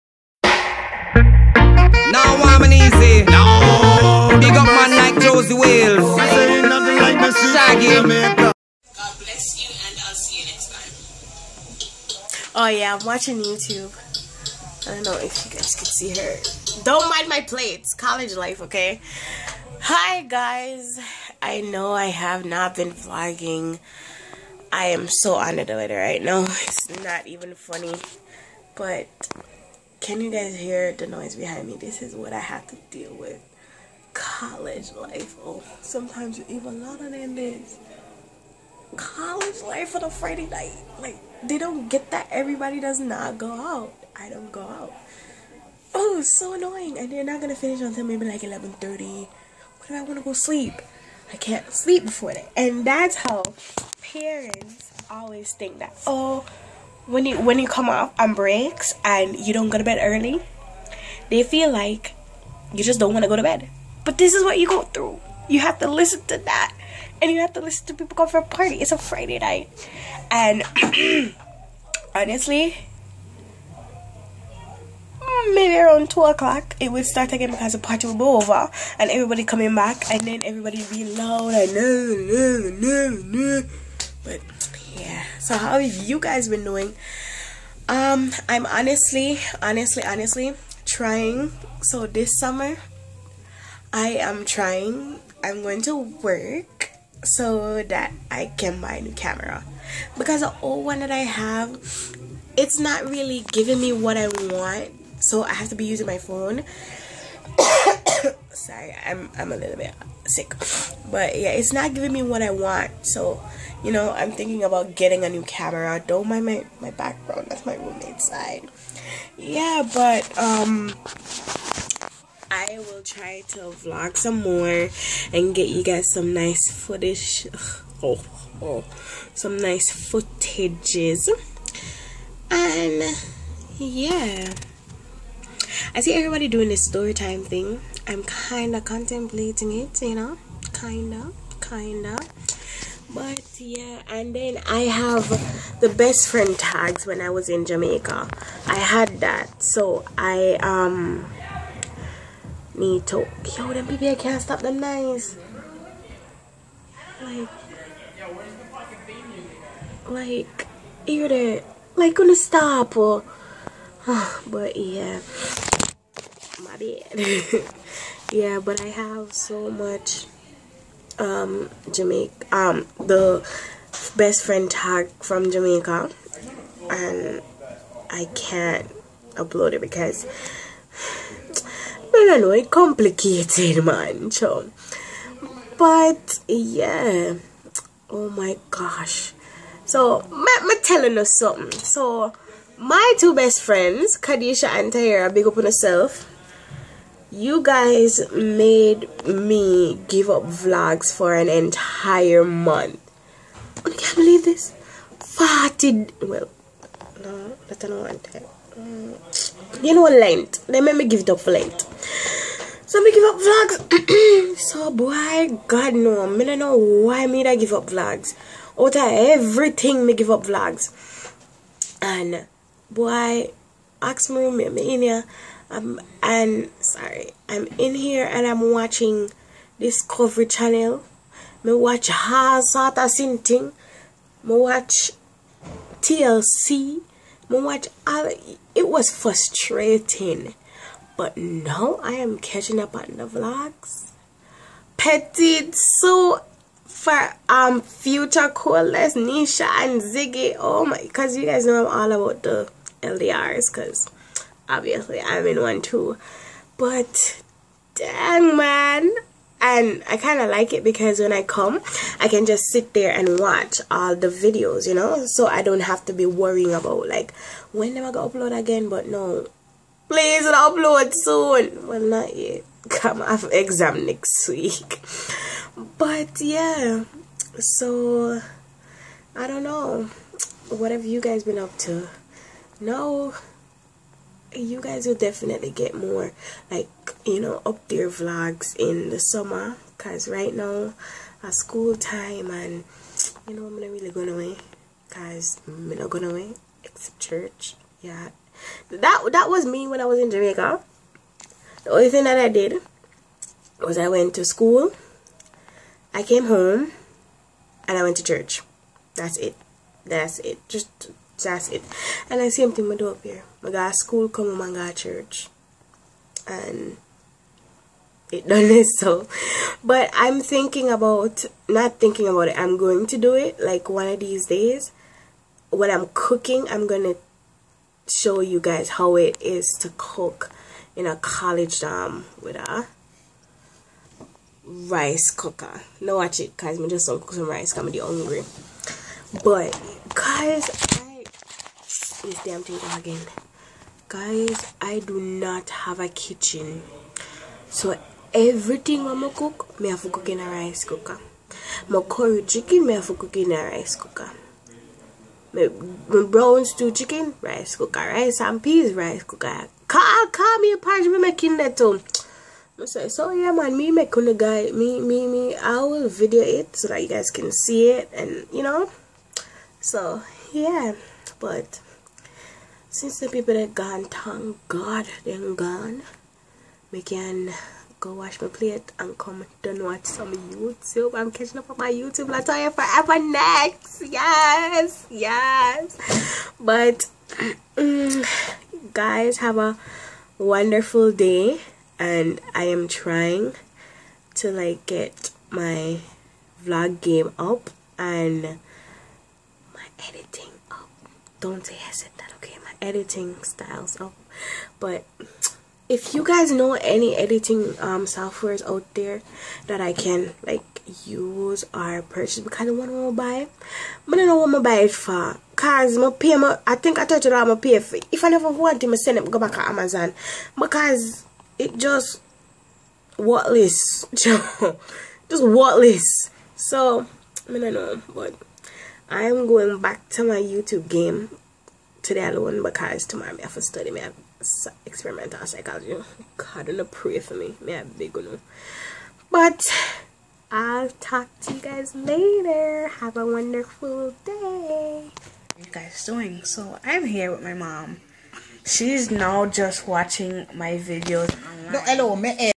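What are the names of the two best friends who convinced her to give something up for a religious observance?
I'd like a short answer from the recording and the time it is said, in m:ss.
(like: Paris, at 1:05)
Kadisha and Tahira, at 3:14.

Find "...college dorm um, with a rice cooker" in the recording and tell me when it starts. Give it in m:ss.
5:31.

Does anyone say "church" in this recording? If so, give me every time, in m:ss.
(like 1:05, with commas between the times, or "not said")
4:57, 5:08, 5:14.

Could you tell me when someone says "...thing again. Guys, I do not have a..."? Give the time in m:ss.
5:42.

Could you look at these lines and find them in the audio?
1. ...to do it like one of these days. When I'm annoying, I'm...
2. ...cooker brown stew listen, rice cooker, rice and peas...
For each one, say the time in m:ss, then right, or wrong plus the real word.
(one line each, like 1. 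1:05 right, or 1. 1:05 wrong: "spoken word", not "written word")
1. 5:23 wrong: "cooking", not "annoying"
2. 5:53 wrong: "chicken", not "listen".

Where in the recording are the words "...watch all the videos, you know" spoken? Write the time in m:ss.
4:23.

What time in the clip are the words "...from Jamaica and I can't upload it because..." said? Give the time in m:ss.
2:55.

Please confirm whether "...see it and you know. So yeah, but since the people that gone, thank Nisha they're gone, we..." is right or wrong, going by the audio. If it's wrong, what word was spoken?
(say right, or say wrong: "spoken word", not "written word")
wrong: "God", not "Nisha".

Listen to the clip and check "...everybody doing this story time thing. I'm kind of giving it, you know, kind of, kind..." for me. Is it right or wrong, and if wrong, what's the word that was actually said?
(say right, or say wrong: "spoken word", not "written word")
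wrong: "contemplating", not "giving".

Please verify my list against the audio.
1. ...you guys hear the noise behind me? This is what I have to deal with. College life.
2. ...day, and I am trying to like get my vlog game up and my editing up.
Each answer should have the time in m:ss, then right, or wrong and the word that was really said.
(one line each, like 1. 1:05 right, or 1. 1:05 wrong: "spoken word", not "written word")
1. 0:30 right
2. 6:31 right.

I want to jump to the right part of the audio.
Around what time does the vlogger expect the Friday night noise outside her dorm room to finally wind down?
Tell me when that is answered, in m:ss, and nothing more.
0:48.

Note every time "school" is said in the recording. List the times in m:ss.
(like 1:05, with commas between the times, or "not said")
4:51, 5:04, 5:13.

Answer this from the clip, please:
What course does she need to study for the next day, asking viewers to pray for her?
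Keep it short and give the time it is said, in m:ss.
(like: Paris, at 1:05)
experimental psychology, at 7:14.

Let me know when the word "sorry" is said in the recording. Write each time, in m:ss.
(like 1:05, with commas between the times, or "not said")
1:48, 3:46.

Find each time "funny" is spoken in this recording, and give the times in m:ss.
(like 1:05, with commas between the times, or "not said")
0:27.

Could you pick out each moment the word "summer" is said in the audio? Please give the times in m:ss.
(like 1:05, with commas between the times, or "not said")
1:32, 4:49.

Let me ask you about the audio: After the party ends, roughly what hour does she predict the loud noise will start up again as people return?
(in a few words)
2 o'clock.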